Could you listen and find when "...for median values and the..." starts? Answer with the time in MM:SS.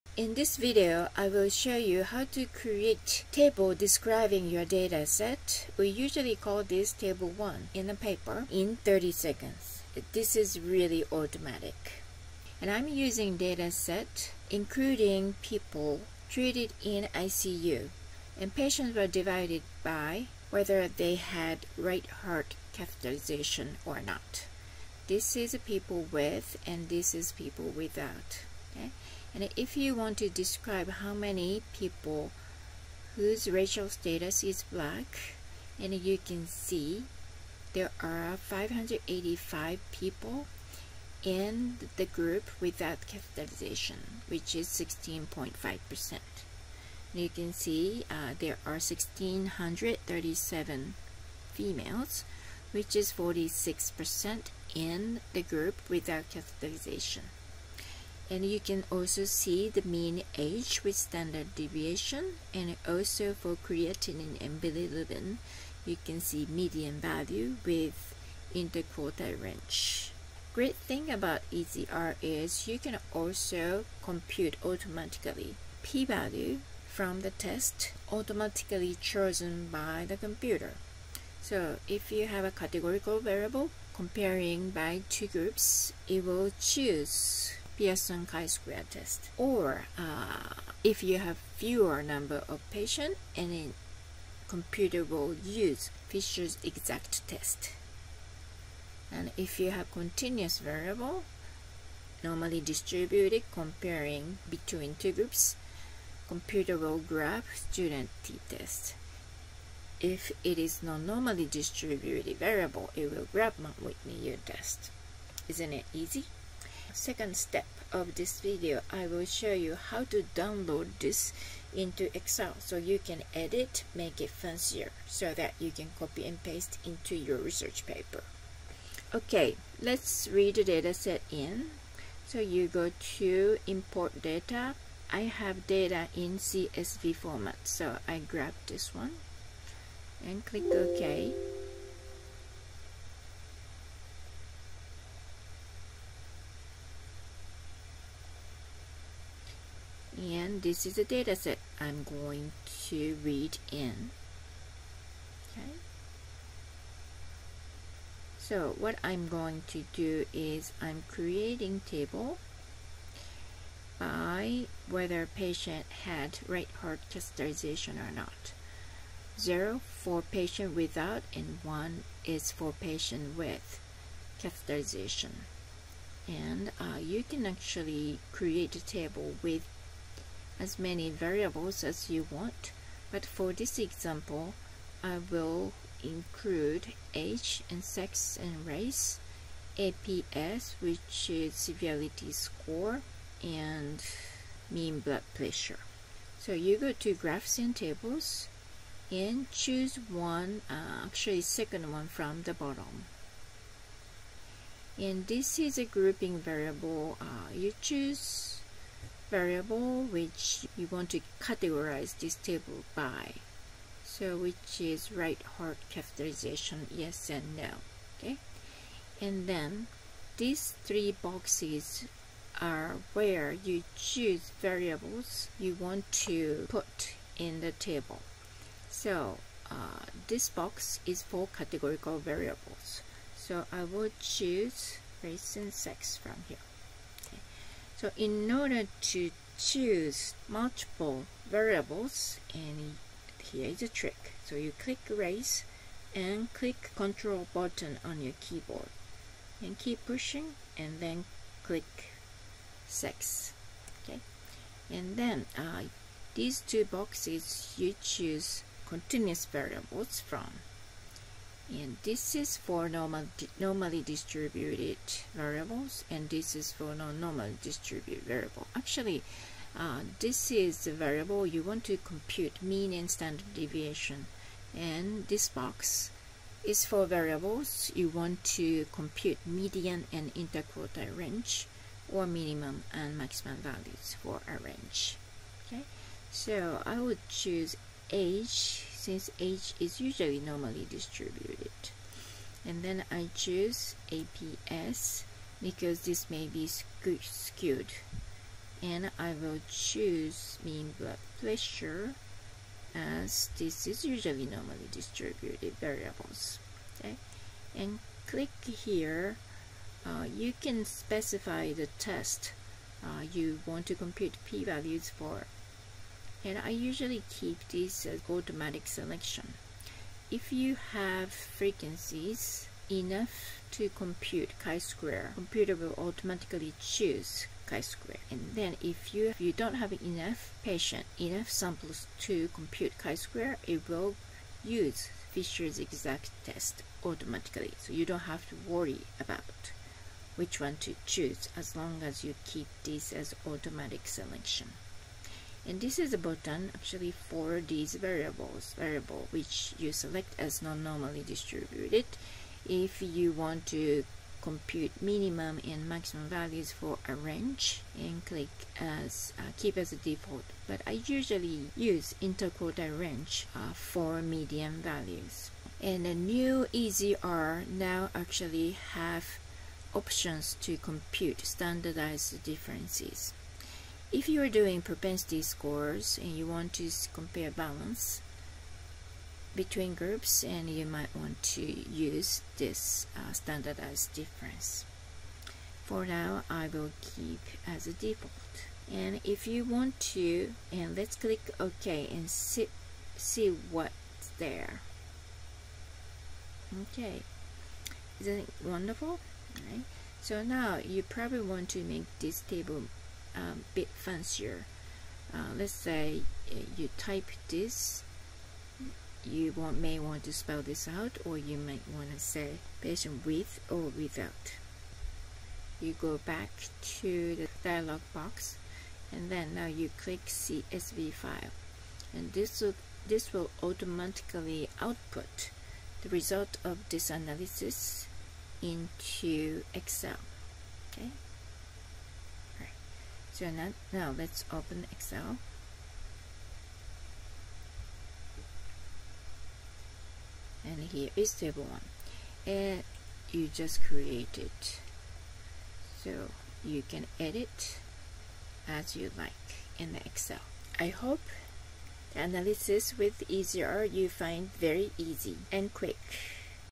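06:03.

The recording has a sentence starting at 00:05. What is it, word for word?
We usually call this table 1 in a paper in 30 seconds.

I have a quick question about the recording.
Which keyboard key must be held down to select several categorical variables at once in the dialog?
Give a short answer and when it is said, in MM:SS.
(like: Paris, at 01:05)
Control, at 04:06.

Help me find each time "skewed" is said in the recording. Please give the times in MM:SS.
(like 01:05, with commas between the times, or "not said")
04:56.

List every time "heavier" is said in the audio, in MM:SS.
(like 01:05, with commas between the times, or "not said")
not said.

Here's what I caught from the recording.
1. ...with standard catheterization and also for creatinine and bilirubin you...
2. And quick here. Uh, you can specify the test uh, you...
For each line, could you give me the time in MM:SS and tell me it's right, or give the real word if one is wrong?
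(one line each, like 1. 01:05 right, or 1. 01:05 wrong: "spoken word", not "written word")
1. 01:00 wrong: "deviation", not "catheterization"
2. 05:07 wrong: "click", not "quick".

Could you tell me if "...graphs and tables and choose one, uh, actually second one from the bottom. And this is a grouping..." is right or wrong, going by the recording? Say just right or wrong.
right.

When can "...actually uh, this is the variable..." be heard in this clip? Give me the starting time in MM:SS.
04:28.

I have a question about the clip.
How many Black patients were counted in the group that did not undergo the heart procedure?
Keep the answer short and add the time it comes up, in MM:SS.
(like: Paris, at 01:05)
585, at 00:38.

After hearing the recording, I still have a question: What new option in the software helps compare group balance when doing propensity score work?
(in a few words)
Standardized differences.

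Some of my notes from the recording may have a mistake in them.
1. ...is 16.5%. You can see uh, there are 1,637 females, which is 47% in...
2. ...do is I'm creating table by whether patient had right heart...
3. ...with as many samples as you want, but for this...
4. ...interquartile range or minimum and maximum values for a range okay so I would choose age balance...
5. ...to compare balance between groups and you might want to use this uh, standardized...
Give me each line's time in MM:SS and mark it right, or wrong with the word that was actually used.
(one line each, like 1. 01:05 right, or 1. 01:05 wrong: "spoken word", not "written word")
1. 00:44 wrong: "46", not "47"
2. 02:39 right
3. 02:59 wrong: "variables", not "samples"
4. 04:40 wrong: "since", not "balance"
5. 06:16 right.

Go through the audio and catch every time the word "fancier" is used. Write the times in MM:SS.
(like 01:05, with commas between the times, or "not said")
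02:04, 06:43.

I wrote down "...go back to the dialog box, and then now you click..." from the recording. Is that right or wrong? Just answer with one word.
right.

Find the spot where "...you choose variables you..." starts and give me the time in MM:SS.
03:43.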